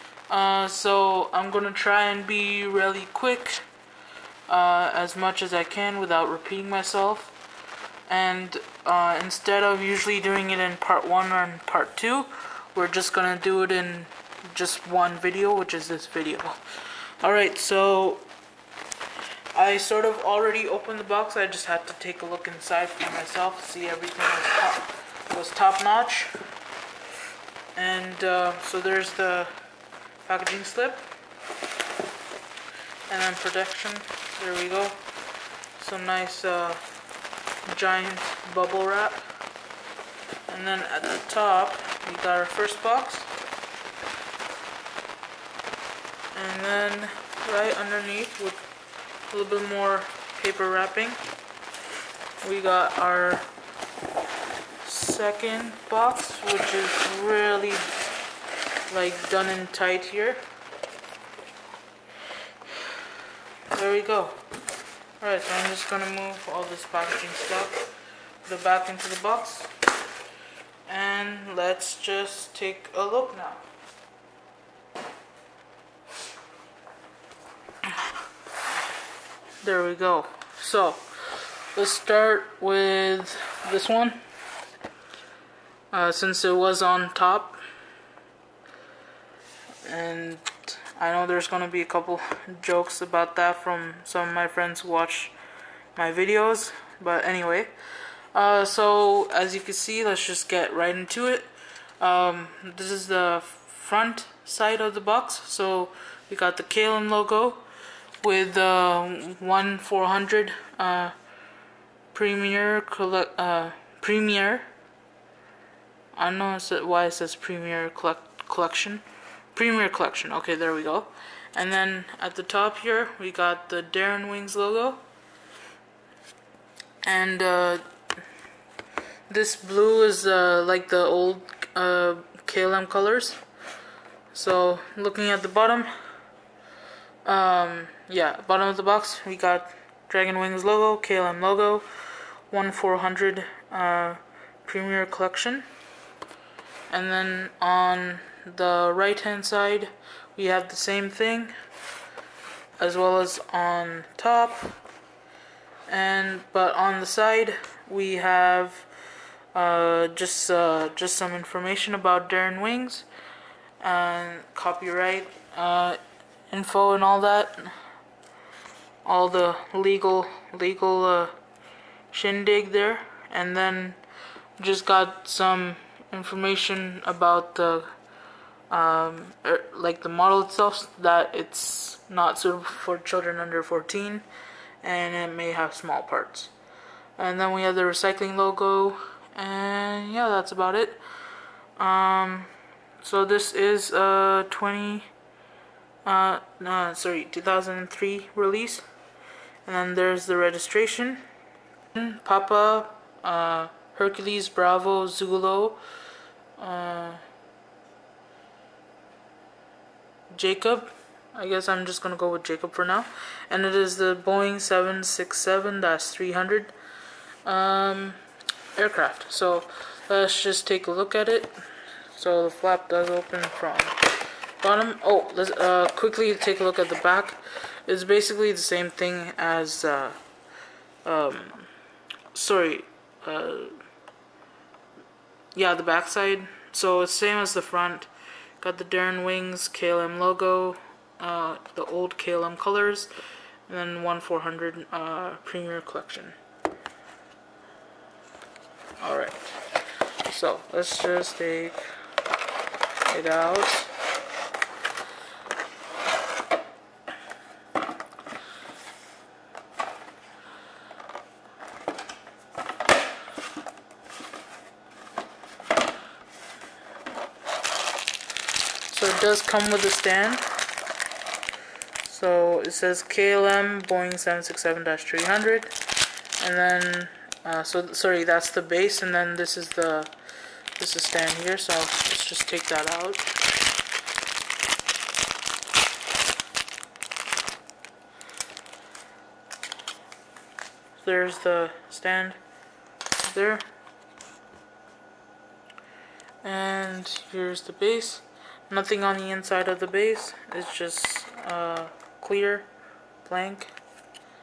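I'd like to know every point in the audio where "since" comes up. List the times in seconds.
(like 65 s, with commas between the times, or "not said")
86 s.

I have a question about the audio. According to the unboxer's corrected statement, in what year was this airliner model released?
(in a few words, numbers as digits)
2003.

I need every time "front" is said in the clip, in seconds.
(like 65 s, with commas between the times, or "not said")
103 s, 237 s.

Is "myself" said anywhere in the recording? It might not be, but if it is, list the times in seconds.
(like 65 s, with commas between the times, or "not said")
6 s, 23 s.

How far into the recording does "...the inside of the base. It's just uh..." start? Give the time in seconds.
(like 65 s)
299 s.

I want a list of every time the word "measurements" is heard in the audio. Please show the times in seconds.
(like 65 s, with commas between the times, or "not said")
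not said.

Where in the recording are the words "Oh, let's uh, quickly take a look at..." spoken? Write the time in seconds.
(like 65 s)
225 s.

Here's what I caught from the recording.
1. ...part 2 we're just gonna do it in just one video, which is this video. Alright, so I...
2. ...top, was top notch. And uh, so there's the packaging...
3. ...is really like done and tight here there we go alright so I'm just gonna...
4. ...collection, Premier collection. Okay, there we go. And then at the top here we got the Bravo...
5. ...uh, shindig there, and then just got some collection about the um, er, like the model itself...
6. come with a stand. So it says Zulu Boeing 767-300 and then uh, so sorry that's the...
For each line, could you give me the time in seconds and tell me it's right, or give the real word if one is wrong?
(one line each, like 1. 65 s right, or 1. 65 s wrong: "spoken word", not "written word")
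1. 11 s right
2. 24 s right
3. 56 s right
4. 118 s wrong: "Dragon", not "Bravo"
5. 171 s wrong: "information", not "collection"
6. 269 s wrong: "KLM", not "Zulu".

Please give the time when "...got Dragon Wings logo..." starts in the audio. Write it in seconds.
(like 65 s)
139 s.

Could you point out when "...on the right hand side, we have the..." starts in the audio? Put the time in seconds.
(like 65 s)
147 s.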